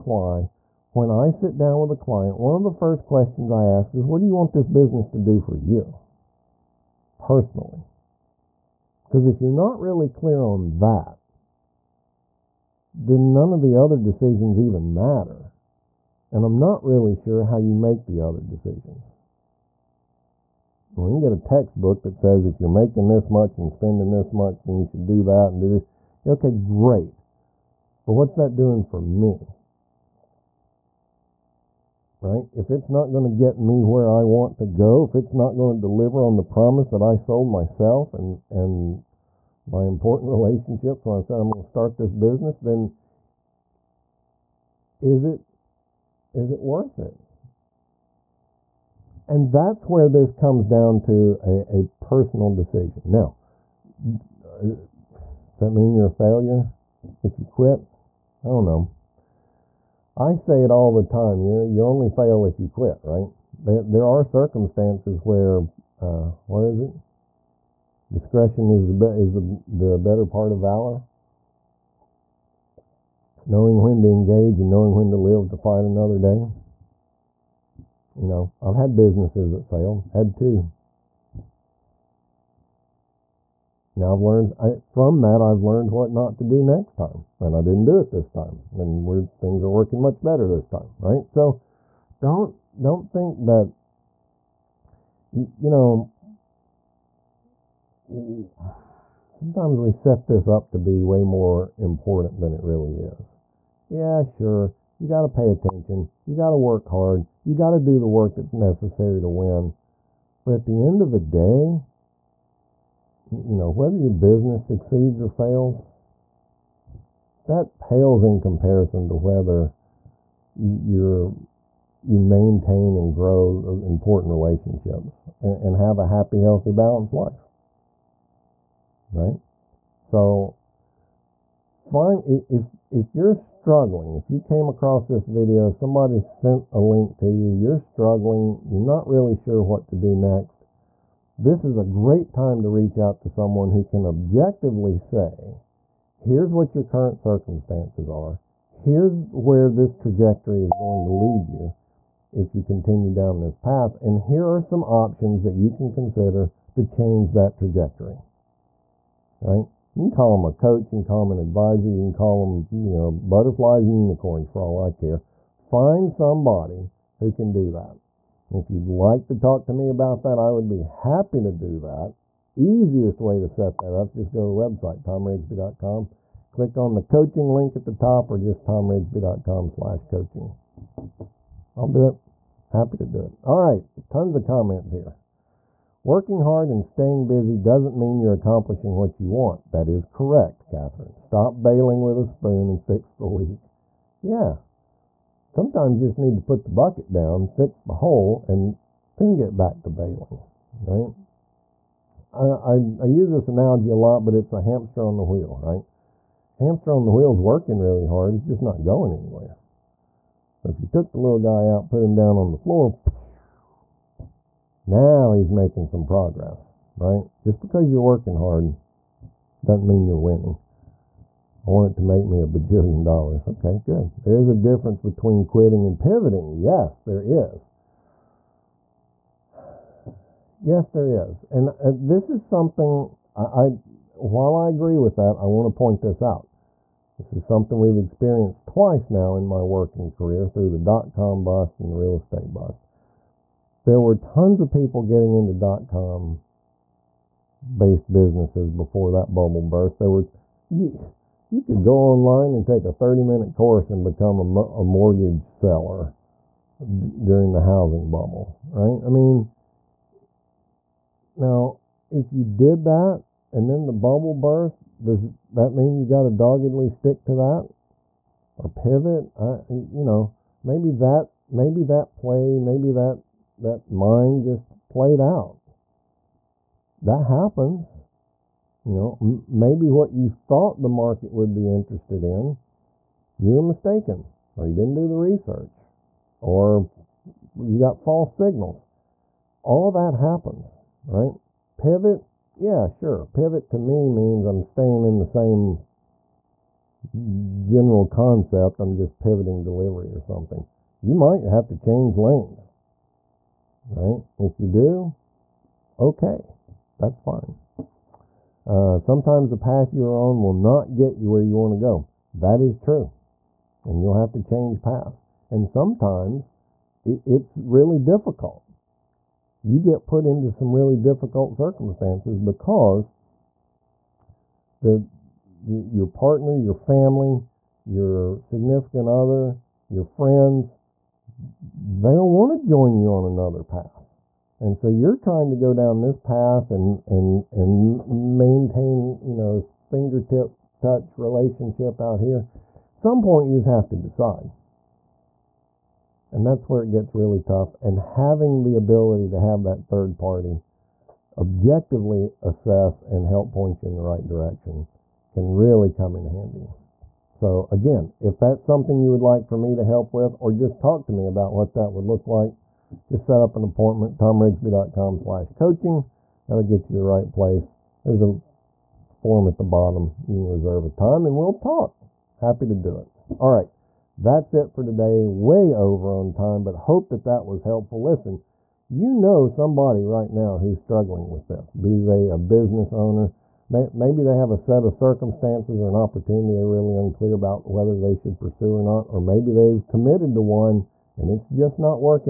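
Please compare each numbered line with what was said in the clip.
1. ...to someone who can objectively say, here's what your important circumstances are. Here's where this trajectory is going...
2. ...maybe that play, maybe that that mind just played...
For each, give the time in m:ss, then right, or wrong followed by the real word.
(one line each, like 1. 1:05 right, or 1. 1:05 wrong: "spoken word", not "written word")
1. 2:23 wrong: "current", not "important"
2. 4:31 right.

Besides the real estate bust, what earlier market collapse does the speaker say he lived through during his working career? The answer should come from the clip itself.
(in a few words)
Dot com bust.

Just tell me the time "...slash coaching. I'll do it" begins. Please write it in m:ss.
2:59.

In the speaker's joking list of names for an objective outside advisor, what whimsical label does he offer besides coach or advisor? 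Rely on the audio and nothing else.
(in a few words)
Butterflies and unicorns.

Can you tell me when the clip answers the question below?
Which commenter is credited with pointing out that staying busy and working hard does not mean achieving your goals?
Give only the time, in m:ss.
3:10.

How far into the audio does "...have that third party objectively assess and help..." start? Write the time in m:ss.
5:49.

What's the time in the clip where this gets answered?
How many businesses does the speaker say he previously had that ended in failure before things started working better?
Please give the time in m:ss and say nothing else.
1:20.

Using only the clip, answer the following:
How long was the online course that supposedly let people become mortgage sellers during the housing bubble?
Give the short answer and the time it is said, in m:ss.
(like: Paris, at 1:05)
30 minutes, at 4:12.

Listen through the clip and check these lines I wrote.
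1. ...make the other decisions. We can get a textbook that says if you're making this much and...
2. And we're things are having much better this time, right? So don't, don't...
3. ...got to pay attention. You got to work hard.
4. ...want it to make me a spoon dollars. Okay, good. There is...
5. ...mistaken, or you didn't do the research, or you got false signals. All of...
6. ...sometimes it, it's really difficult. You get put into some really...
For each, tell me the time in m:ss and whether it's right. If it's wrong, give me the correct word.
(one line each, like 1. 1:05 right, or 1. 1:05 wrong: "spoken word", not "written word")
1. 0:17 right
2. 1:28 wrong: "working", not "having"
3. 1:45 right
4. 3:41 wrong: "bajillion", not "spoon"
5. 4:43 right
6. 5:15 right.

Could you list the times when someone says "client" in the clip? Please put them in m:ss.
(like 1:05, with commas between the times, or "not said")
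0:01.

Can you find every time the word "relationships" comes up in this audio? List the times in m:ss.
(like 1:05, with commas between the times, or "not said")
0:40, 2:04, 5:41.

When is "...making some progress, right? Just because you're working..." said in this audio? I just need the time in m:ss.
3:35.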